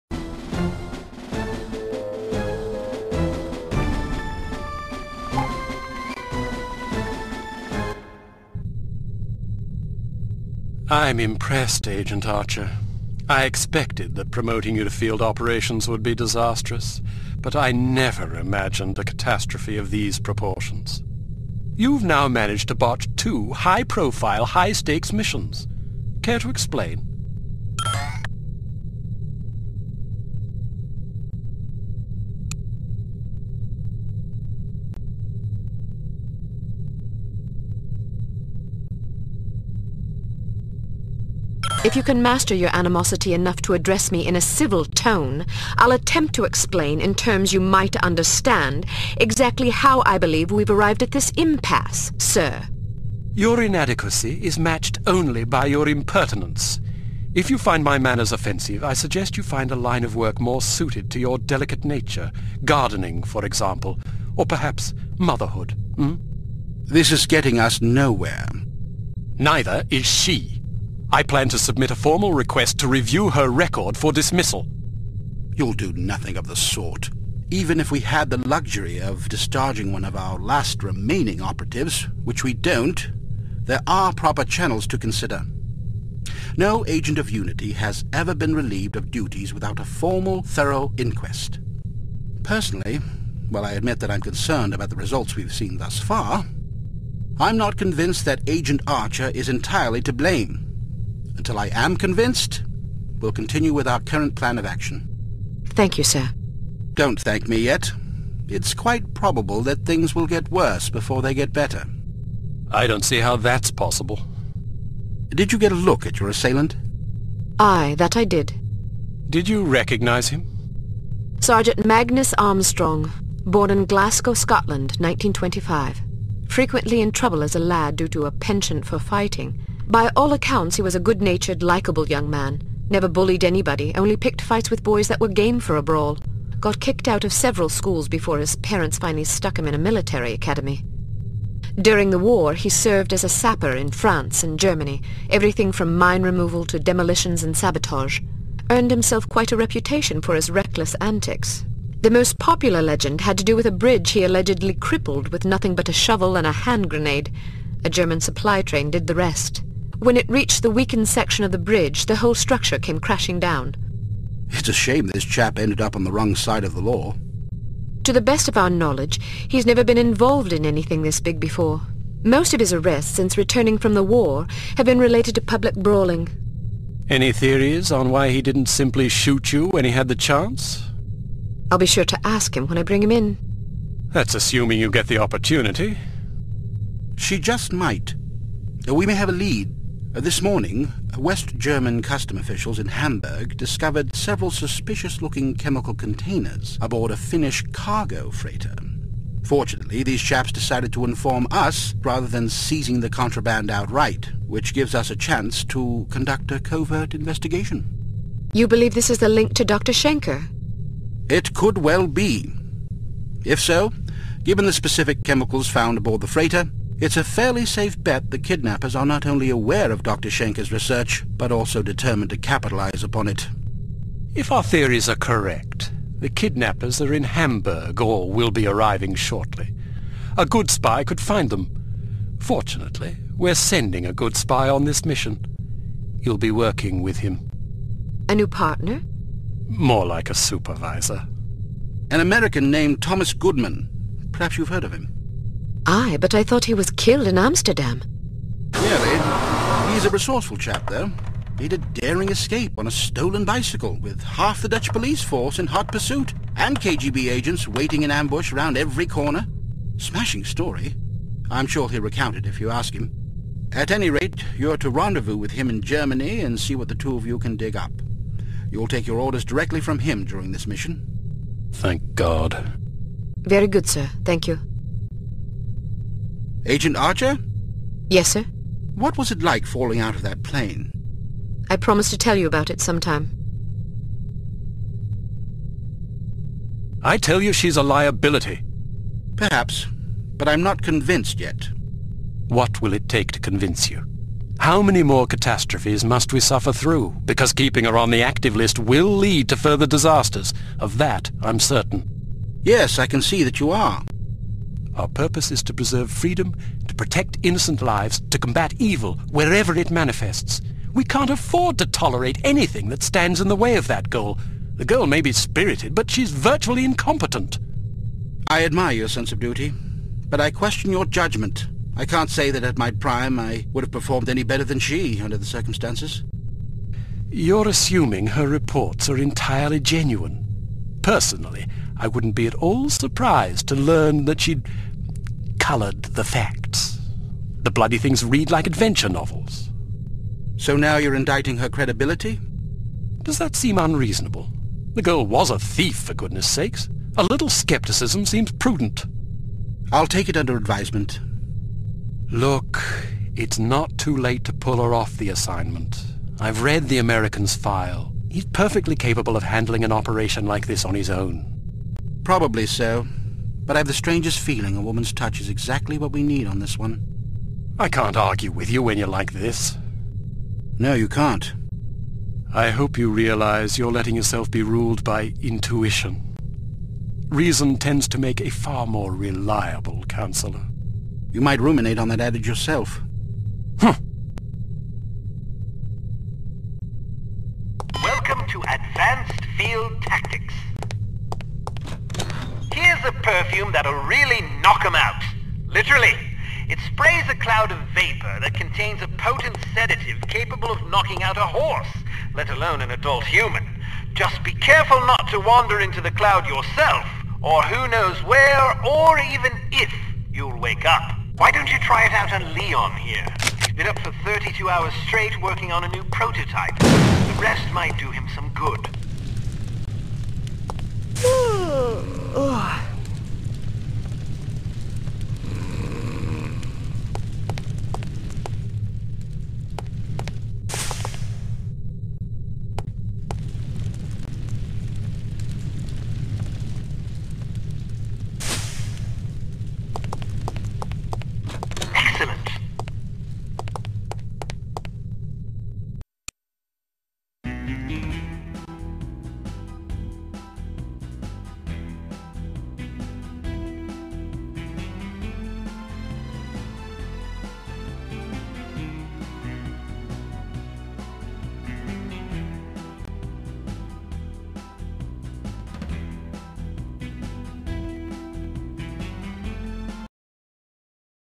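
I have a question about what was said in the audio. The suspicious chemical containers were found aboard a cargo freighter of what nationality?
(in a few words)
Finnish.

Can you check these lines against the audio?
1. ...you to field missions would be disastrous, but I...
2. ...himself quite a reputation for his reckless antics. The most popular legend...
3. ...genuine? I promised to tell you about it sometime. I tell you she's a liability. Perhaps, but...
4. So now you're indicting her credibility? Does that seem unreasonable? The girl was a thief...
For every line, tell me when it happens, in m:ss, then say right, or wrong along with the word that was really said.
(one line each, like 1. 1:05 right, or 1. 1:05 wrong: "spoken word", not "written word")
1. 0:14 wrong: "operations", not "missions"
2. 2:28 right
3. 4:40 wrong: "plane", not "genuine"
4. 5:40 right.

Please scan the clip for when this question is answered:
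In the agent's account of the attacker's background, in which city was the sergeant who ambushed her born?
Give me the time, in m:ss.
2:03.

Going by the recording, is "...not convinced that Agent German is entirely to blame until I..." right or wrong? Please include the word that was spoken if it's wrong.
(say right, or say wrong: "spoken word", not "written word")
wrong: "Archer", not "German".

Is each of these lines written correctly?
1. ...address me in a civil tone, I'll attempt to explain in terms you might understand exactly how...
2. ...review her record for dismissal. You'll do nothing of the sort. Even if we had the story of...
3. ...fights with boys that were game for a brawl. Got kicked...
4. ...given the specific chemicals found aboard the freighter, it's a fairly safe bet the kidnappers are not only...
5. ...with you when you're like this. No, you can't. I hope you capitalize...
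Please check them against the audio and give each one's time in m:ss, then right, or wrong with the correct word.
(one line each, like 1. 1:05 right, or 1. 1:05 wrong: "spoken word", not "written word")
1. 0:43 right
2. 1:12 wrong: "luxury", not "story"
3. 2:14 right
4. 3:34 right
5. 6:08 wrong: "realize", not "capitalize".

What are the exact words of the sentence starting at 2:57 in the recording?
Any theories on why he didn't simply shoot you when he had the chance?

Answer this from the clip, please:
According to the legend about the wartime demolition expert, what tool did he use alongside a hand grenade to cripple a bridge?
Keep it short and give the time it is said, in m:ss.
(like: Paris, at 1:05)
A shovel, at 2:35.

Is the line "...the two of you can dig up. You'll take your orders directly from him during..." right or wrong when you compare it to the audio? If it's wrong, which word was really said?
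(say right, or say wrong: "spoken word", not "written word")
right.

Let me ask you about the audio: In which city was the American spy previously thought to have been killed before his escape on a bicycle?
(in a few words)
Amsterdam.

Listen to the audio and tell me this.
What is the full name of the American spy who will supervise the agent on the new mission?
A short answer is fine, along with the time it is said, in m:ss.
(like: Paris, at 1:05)
Thomas Goodman, at 4:03.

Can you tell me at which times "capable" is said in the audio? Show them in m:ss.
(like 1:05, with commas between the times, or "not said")
5:58, 6:40.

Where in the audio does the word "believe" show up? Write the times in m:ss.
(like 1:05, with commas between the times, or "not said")
0:50, 3:28.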